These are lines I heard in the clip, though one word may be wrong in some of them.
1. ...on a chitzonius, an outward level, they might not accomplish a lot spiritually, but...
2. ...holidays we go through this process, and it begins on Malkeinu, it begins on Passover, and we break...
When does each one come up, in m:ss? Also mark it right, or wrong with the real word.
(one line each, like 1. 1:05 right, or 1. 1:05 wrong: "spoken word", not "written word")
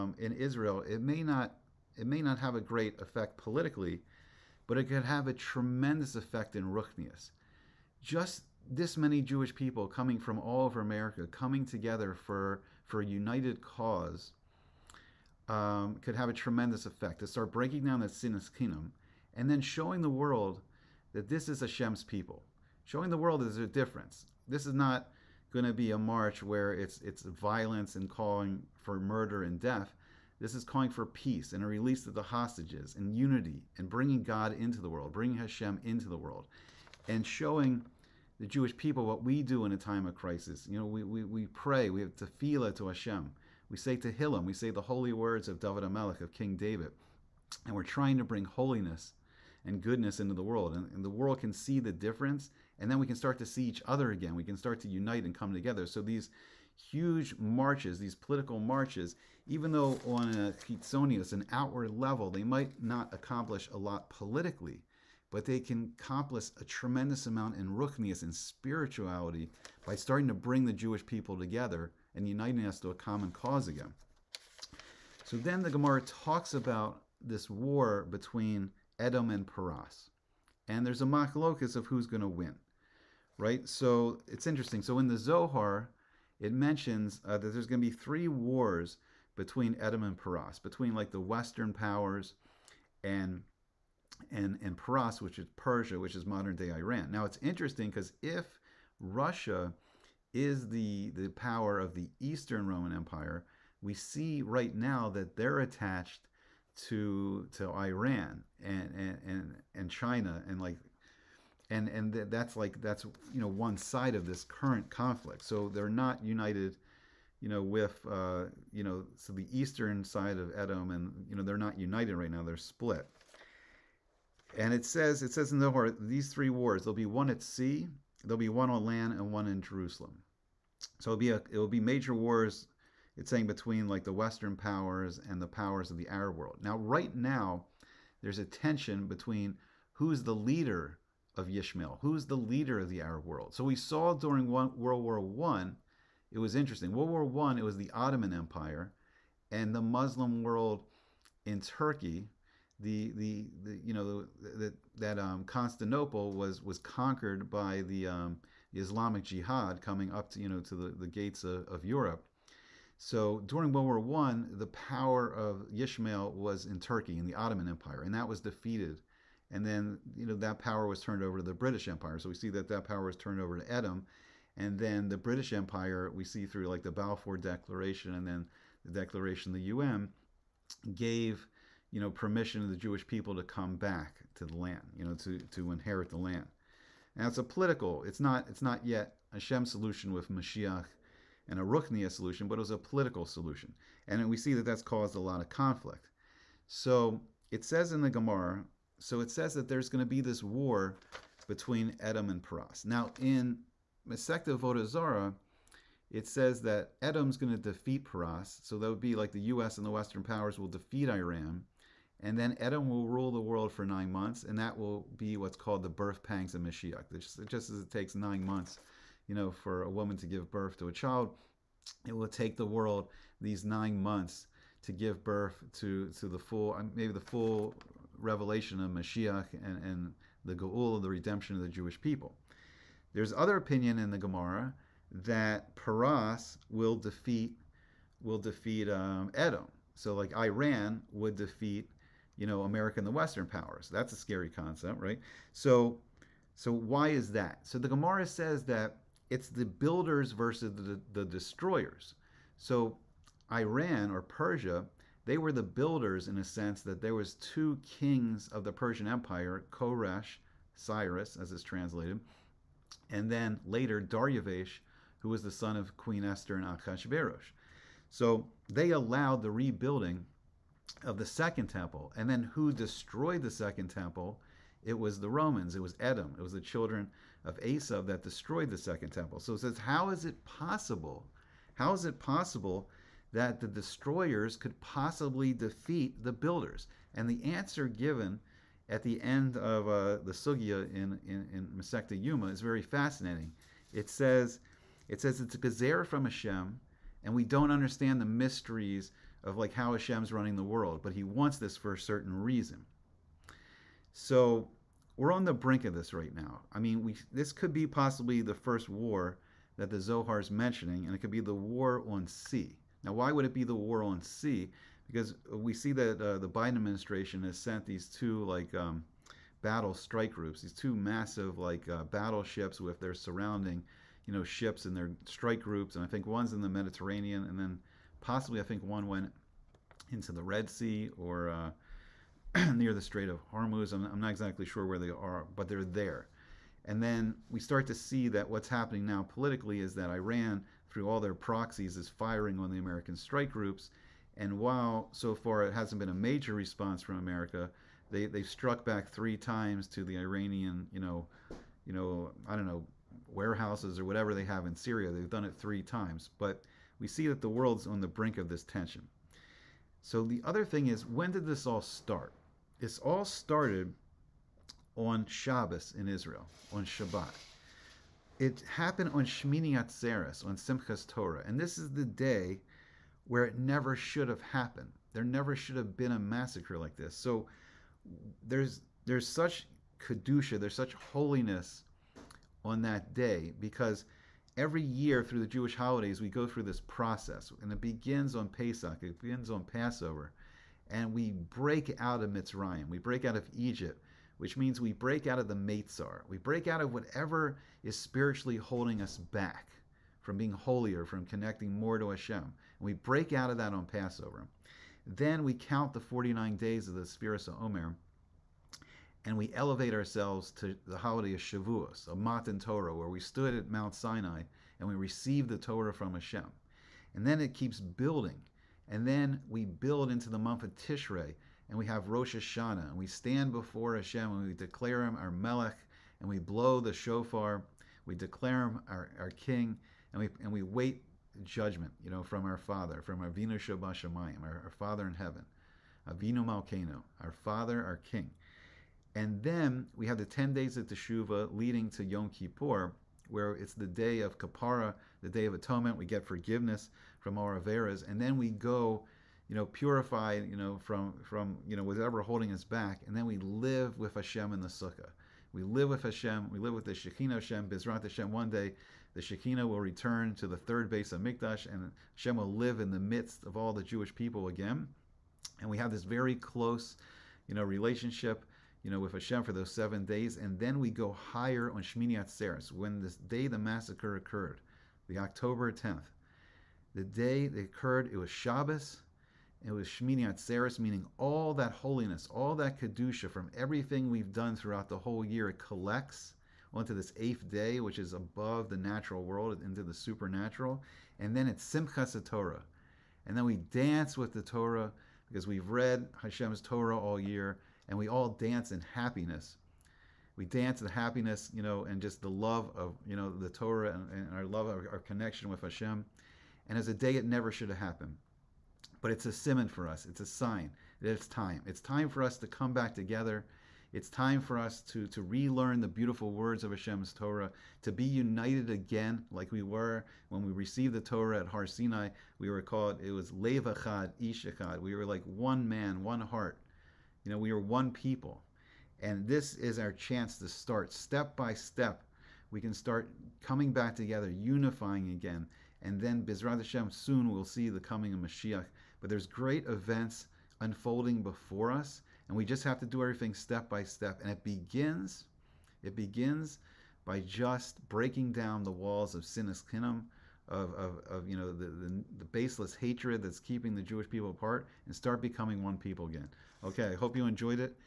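1. 1:00 wrong: "politically", not "spiritually"
2. 6:25 wrong: "Pesach", not "Malkeinu".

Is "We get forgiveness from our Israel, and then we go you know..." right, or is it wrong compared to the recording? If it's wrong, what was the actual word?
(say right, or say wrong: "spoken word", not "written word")
wrong: "Averas", not "Israel".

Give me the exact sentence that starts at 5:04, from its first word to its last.
So we're on the brink of this right now.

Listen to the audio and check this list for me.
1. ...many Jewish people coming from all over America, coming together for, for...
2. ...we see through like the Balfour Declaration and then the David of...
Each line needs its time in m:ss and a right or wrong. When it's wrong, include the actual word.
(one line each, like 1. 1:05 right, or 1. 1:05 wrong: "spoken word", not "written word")
1. 0:08 right
2. 2:56 wrong: "Declaration", not "David".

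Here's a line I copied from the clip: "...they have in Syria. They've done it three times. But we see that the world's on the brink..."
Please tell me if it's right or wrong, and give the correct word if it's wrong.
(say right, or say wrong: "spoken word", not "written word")
right.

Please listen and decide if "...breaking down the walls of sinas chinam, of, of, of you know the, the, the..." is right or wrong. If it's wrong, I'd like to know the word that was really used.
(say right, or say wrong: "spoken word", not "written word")
right.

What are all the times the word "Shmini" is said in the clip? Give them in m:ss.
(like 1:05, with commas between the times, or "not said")
6:09, 7:51, 7:59.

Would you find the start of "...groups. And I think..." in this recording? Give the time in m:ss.
5:25.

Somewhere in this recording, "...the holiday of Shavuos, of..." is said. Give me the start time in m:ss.
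6:50.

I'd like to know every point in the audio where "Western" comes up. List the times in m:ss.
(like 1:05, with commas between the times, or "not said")
1:31, 2:14, 3:29, 4:03.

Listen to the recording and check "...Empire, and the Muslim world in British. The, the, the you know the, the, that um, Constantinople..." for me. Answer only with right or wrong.
wrong.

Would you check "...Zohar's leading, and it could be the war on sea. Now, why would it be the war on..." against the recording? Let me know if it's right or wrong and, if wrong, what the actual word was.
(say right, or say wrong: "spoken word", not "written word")
wrong: "mentioning", not "leading".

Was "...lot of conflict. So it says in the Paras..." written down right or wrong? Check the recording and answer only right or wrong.
wrong.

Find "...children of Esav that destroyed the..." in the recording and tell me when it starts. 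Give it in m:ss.
4:36.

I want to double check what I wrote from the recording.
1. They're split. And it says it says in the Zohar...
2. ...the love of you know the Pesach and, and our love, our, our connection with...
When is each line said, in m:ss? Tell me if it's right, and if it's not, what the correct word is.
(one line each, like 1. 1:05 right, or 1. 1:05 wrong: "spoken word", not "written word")
1. 2:02 right
2. 8:22 wrong: "Torah", not "Pesach".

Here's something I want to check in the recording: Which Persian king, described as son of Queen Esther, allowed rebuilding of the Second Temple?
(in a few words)
Daryavesh.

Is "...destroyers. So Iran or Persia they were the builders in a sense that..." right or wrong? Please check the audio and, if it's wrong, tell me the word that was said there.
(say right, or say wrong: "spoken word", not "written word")
right.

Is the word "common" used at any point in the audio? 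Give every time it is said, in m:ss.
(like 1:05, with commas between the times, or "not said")
1:12.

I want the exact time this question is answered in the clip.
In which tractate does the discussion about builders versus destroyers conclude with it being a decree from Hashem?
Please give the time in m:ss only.
4:52.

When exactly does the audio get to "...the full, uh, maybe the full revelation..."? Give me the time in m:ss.
3:46.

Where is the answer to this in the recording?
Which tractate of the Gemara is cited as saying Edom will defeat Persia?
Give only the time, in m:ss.
3:24.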